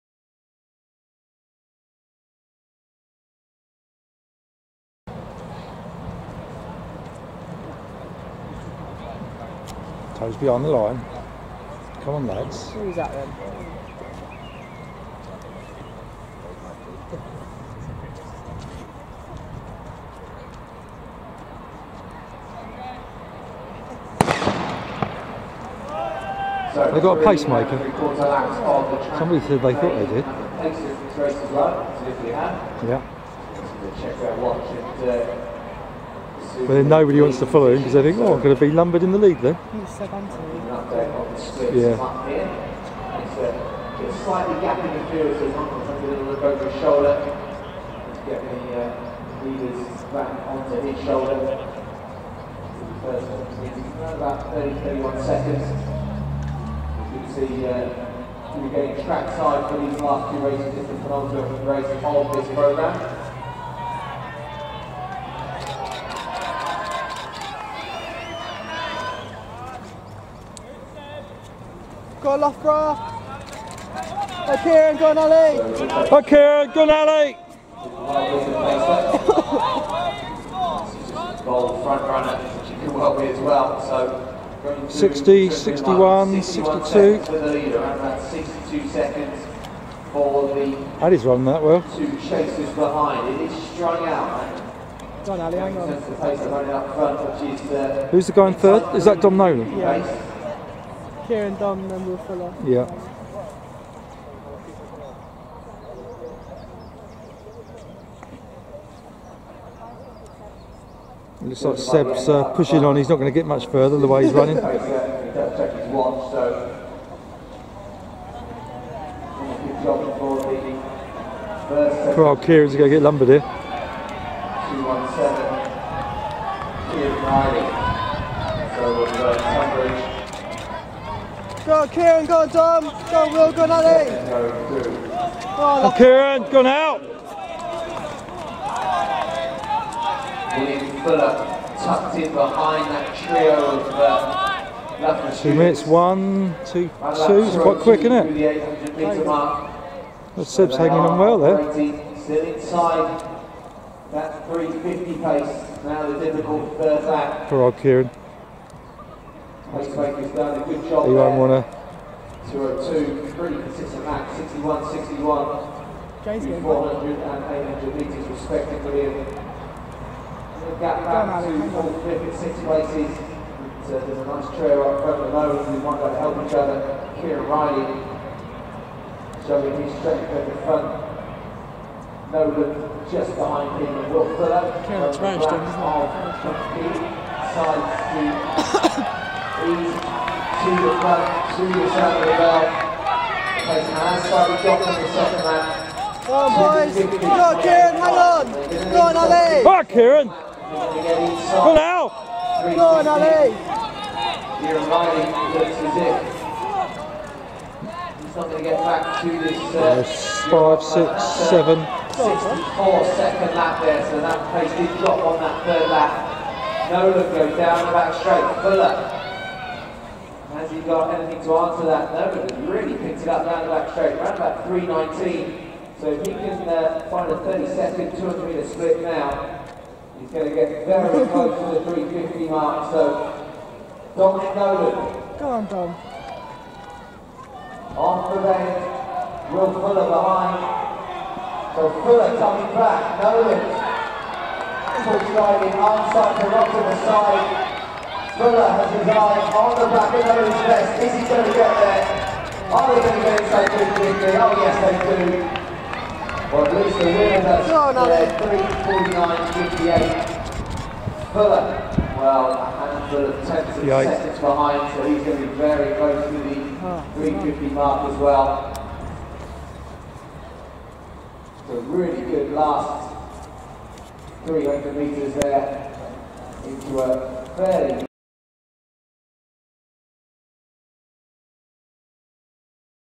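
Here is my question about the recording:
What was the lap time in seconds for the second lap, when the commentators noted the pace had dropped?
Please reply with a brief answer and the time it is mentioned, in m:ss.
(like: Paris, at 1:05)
64, at 3:32.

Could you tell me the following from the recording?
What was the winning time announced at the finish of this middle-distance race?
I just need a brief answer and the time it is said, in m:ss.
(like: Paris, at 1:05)
3:49.58, at 4:18.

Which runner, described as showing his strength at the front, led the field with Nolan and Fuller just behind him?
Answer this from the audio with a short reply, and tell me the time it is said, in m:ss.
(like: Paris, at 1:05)
Kieran Riley, at 2:57.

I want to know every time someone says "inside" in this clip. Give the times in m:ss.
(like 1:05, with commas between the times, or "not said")
2:32, 4:13.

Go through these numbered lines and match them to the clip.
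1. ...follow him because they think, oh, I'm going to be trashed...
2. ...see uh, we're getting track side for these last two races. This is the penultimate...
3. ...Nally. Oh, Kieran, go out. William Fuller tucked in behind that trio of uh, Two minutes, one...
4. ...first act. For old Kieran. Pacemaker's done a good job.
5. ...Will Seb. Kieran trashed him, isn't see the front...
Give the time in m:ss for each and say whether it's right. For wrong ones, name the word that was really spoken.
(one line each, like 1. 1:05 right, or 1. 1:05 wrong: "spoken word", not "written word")
1. 0:37 wrong: "lumbered", not "trashed"
2. 0:57 right
3. 2:13 right
4. 2:36 right
5. 3:04 wrong: "Fuller", not "Seb".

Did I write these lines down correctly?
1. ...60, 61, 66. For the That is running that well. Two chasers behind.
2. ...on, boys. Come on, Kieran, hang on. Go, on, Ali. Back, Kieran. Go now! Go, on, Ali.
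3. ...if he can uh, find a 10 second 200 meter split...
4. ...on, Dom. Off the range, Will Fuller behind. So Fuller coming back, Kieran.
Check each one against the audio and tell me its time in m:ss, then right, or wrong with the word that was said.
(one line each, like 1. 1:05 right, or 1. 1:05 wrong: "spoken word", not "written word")
1. 1:24 wrong: "62", not "66"
2. 3:16 right
3. 3:46 wrong: "30", not "10"
4. 3:55 wrong: "Nolan", not "Kieran".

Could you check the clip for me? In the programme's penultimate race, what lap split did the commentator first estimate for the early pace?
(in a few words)
30, 31 seconds.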